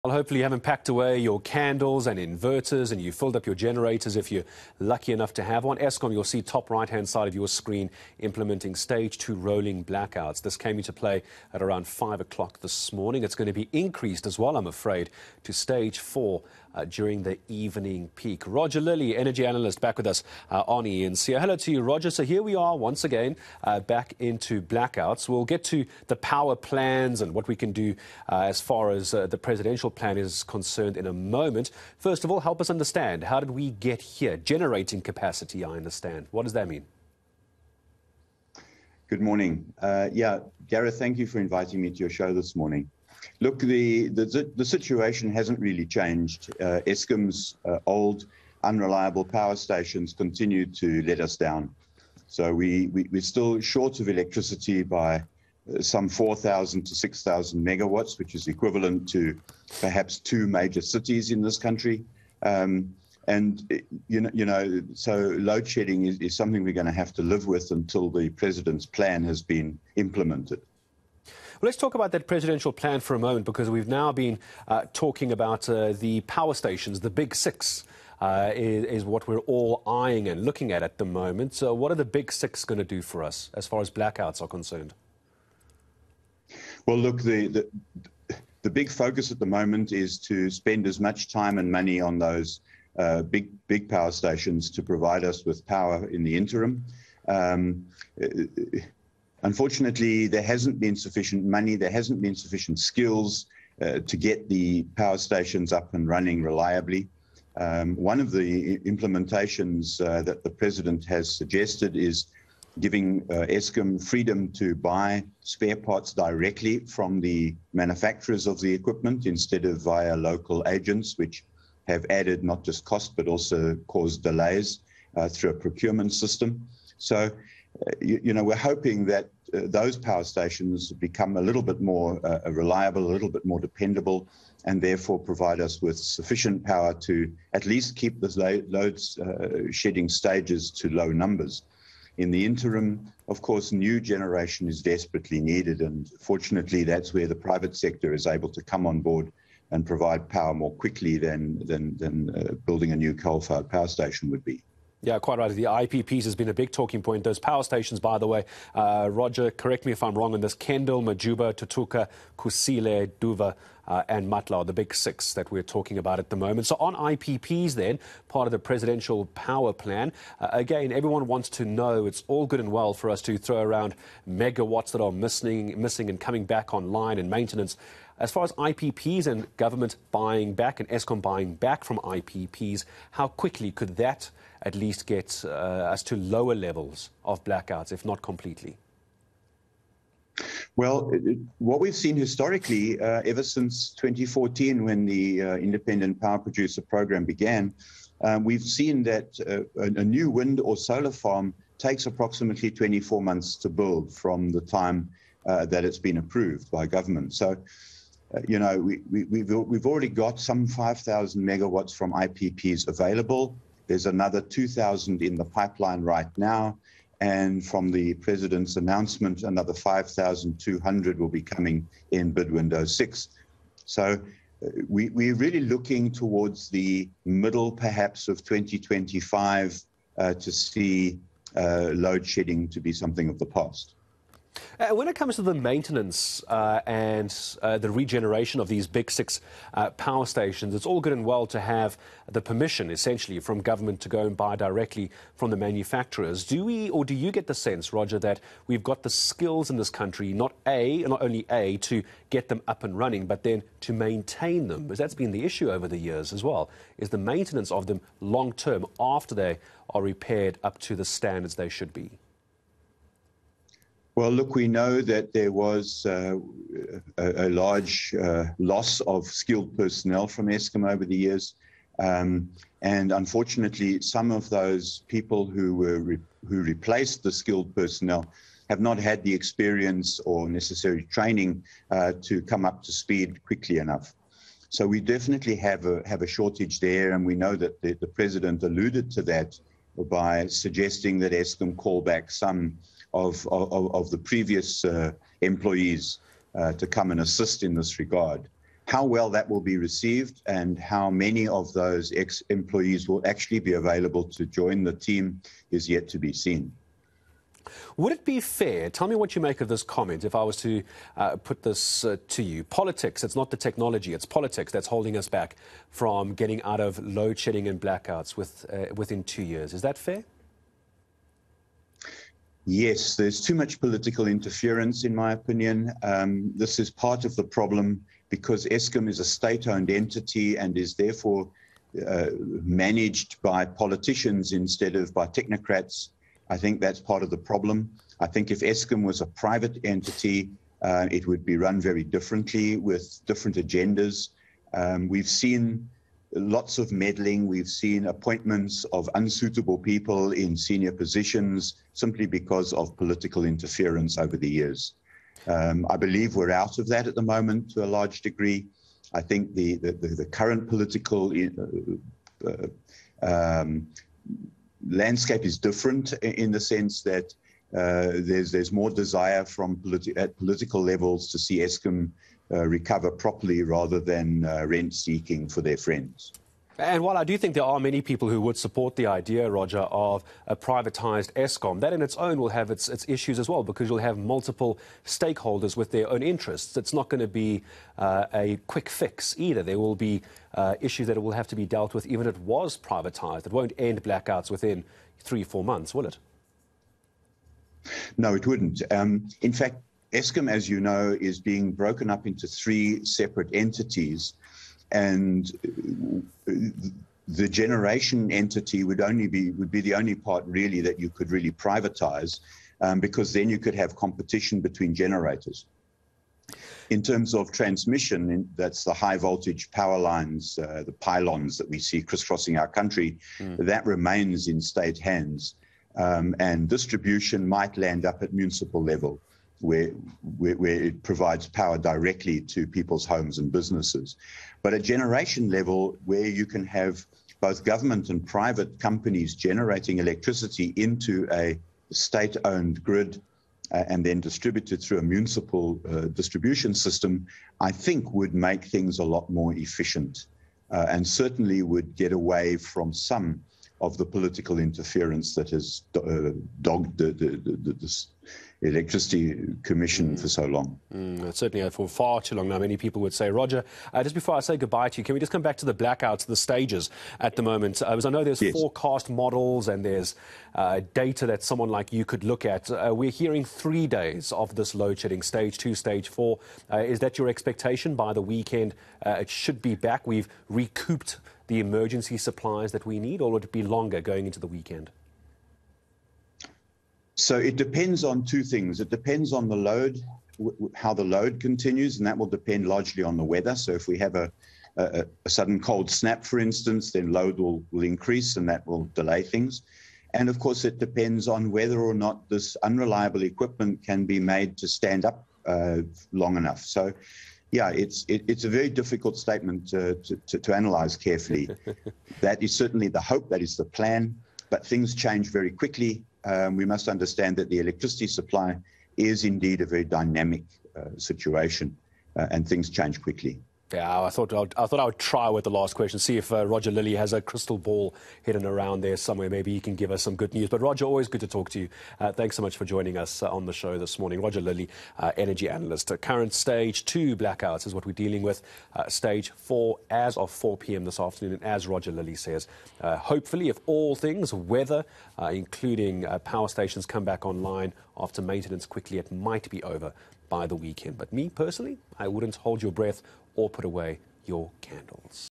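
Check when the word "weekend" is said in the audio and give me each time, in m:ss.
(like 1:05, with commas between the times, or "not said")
7:58, 8:04, 9:10.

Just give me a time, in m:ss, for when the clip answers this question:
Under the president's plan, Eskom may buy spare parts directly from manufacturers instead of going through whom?
2:00.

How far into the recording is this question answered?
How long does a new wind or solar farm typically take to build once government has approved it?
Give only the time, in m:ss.
3:22.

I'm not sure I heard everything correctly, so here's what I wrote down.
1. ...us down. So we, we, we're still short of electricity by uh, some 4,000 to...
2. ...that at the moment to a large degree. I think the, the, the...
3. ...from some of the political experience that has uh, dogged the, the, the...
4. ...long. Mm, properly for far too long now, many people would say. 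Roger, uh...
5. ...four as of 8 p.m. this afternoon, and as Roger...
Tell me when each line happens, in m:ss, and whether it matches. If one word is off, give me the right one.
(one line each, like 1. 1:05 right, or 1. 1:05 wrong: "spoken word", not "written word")
1. 0:51 right
2. 5:56 right
3. 7:32 wrong: "interference", not "experience"
4. 7:40 wrong: "certainly", not "properly"
5. 8:59 wrong: "4", not "8".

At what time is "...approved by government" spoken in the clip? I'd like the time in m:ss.
3:26.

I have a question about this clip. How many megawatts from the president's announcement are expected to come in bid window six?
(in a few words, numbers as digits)
5,200.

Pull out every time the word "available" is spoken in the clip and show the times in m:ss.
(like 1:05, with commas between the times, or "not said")
3:32, 5:03.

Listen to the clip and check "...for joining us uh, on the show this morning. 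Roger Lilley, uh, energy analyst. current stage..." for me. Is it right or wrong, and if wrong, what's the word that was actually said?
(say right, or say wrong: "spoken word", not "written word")
right.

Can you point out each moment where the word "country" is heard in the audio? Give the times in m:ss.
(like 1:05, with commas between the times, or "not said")
1:01, 4:09, 7:02.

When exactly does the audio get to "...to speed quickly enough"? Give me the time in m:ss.
4:42.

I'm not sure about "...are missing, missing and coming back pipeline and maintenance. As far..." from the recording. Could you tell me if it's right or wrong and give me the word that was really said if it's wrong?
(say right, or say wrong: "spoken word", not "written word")
wrong: "online", not "pipeline".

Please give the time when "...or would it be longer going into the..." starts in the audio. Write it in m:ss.
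8:03.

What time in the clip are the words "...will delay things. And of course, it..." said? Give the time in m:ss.
8:18.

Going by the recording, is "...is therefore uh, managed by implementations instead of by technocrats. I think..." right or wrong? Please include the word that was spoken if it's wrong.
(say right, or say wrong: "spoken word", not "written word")
wrong: "politicians", not "implementations".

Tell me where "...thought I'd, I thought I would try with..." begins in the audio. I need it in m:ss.
8:44.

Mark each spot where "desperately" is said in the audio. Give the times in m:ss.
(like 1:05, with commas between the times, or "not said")
2:24.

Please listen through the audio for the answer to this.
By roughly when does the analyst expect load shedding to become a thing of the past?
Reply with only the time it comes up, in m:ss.
3:47.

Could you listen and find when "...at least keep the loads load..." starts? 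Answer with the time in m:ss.
2:17.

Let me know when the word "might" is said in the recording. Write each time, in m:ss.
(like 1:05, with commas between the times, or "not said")
7:07, 9:09.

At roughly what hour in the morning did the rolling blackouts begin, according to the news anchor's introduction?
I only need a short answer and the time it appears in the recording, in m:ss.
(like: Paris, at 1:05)
5 o'clock, at 0:11.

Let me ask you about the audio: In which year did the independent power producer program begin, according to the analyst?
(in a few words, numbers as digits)
2014.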